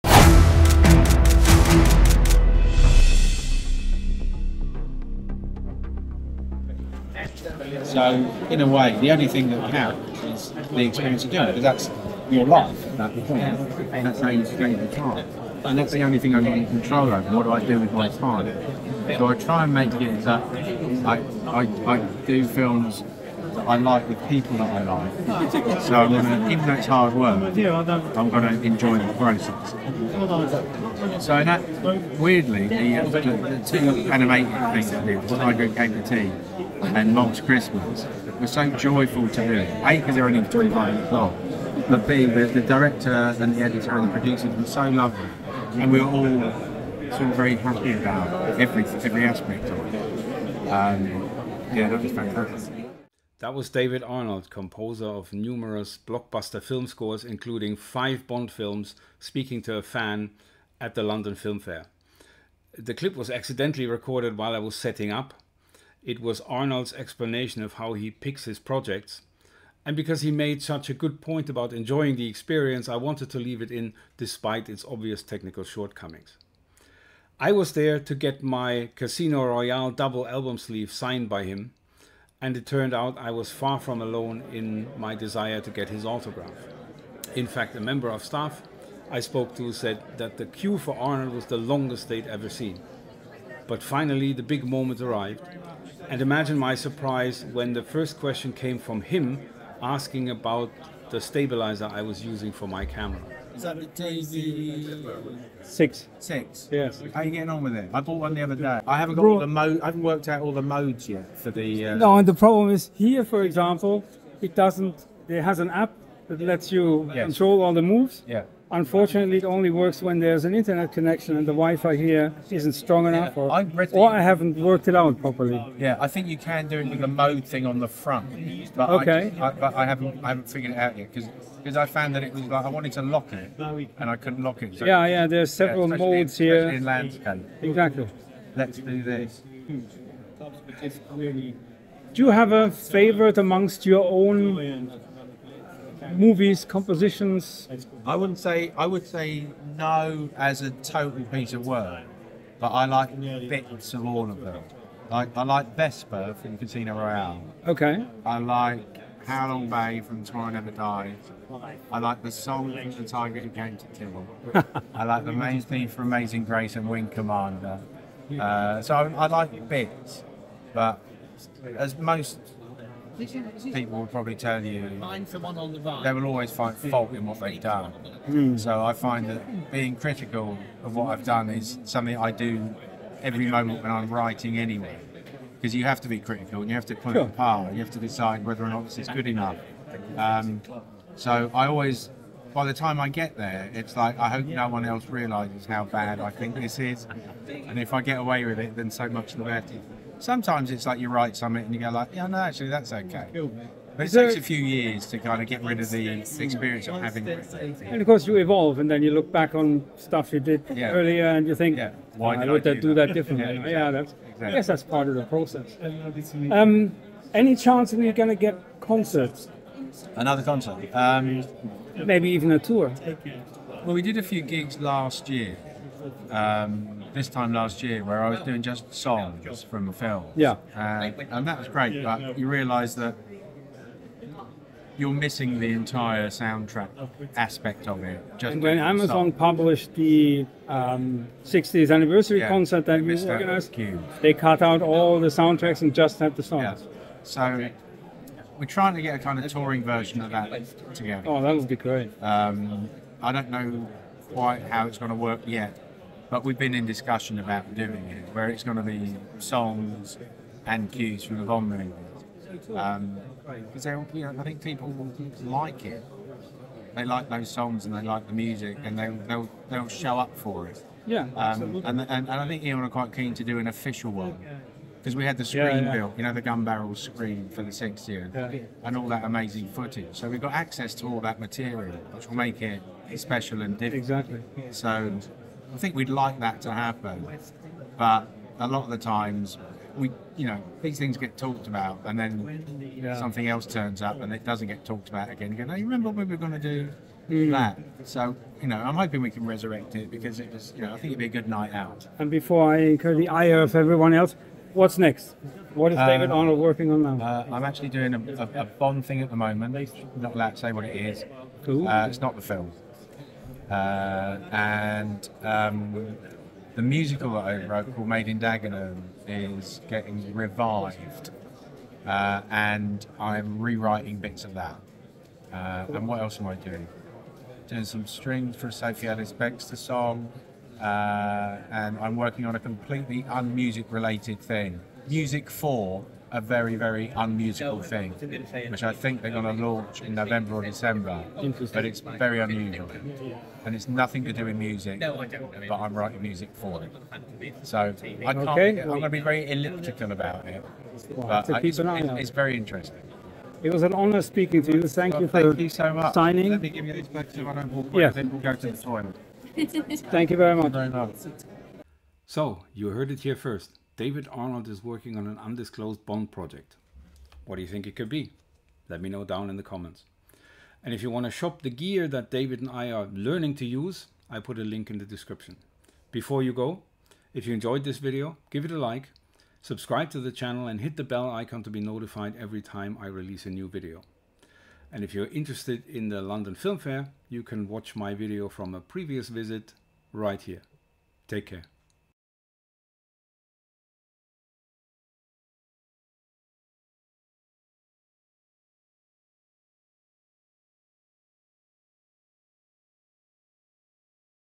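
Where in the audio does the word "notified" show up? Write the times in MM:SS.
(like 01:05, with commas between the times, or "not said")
06:21.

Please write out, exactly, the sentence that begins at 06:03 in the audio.
David Arnold is working on an undisclosed Bond project.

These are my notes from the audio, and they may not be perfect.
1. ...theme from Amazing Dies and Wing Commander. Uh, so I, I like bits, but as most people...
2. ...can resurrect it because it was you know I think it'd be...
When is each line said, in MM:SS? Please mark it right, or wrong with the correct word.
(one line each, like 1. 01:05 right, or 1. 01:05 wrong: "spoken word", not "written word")
1. 02:45 wrong: "Grace", not "Dies"
2. 04:59 right.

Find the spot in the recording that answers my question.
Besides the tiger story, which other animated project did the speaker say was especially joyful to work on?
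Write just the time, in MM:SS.
00:37.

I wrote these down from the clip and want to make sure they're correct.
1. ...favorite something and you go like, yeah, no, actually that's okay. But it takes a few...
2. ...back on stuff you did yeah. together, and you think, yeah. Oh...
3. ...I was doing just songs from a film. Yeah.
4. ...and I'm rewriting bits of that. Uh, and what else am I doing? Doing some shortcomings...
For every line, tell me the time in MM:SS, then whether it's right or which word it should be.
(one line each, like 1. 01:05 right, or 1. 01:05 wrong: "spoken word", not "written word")
1. 03:21 wrong: "write", not "favorite"
2. 03:29 wrong: "earlier", not "together"
3. 03:48 right
4. 05:22 wrong: "strings", not "shortcomings".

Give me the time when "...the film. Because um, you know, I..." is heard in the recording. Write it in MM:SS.
04:21.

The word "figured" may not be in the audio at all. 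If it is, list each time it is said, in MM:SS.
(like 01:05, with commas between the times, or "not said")
02:10.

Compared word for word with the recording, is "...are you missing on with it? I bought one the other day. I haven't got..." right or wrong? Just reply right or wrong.
wrong.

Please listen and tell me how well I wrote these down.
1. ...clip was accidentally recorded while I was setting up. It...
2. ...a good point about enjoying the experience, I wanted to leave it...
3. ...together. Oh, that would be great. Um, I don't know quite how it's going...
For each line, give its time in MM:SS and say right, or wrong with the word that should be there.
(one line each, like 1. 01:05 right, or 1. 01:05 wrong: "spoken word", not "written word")
1. 01:02 right
2. 01:10 right
3. 04:10 right.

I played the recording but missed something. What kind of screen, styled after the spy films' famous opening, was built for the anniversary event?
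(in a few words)
Gun barrel screen.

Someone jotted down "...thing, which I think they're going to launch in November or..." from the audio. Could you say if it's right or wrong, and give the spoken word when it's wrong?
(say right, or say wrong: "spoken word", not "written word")
right.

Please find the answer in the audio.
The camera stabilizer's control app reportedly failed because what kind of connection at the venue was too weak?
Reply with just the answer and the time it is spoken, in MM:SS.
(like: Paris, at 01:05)
Wi-Fi, at 02:01.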